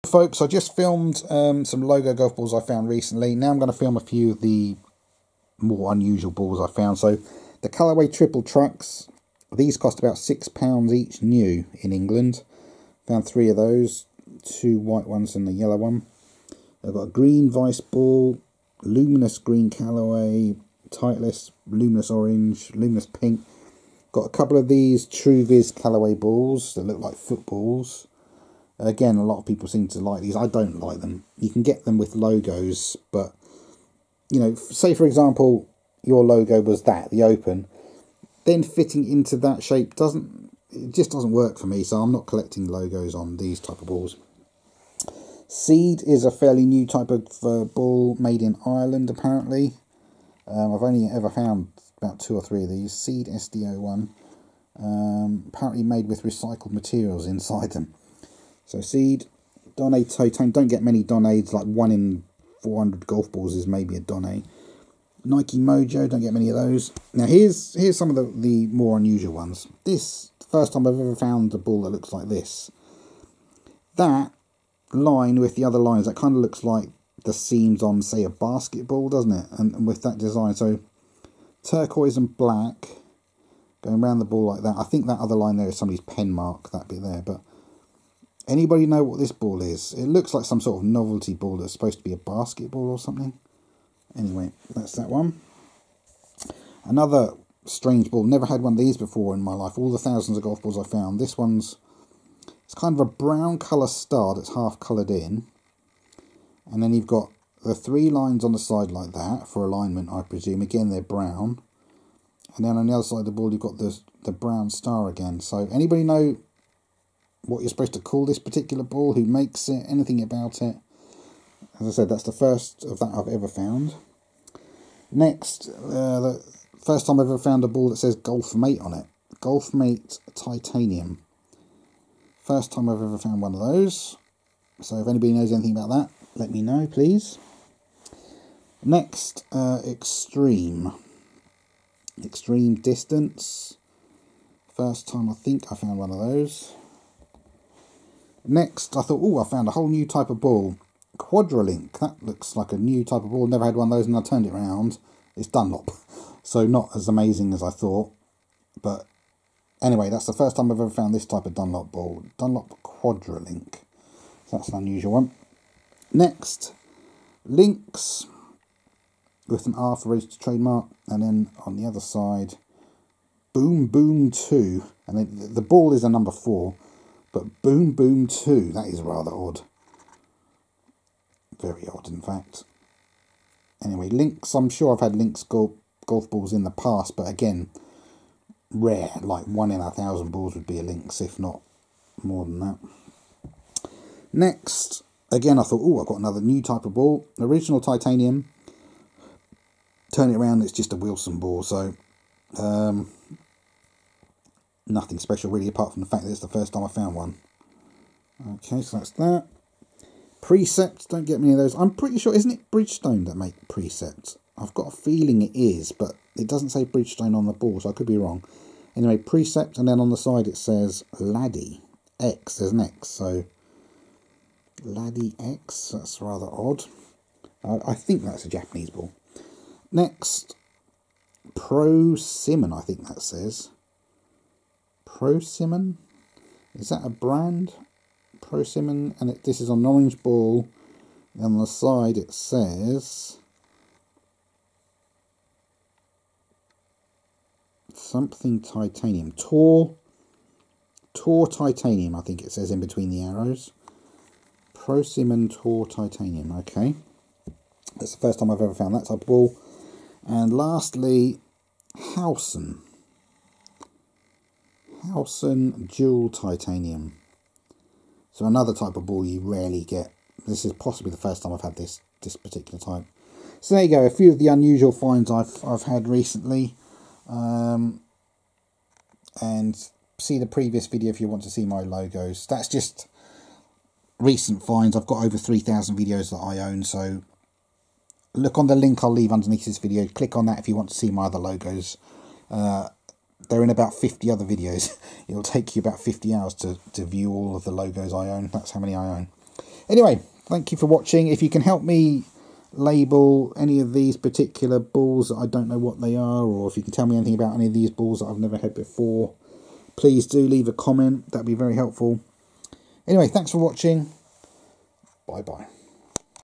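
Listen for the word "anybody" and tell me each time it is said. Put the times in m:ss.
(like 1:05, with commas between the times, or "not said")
1:28, 1:55, 2:15.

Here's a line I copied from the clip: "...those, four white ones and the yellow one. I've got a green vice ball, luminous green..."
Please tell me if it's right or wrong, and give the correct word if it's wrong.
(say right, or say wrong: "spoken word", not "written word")
wrong: "two", not "four".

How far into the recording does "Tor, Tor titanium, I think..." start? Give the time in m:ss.
4:09.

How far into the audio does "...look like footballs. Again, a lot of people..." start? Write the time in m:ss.
0:26.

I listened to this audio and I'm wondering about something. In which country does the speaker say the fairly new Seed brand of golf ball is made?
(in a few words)
Ireland.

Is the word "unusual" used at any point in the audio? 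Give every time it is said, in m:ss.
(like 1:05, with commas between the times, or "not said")
0:05, 1:08, 2:44, 4:34.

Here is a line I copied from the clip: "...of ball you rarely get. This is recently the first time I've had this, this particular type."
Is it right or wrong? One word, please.
wrong.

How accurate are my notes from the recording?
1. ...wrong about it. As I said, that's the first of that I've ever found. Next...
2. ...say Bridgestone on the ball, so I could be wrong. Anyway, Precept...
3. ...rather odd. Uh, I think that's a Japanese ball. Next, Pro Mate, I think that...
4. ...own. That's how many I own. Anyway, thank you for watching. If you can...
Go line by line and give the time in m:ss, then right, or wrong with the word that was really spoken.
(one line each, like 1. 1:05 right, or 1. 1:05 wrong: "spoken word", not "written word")
1. 1:59 wrong: "anything", not "wrong"
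2. 3:36 right
3. 3:46 wrong: "Simon", not "Mate"
4. 4:58 right.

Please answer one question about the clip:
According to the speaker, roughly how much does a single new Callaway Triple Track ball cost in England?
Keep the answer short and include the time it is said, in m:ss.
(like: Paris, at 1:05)
£6, at 0:10.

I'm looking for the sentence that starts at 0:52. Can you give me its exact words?
Seed SDO1, um, apparently made with recycled materials inside them.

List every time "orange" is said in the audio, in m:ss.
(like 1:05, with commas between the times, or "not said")
0:22, 3:59.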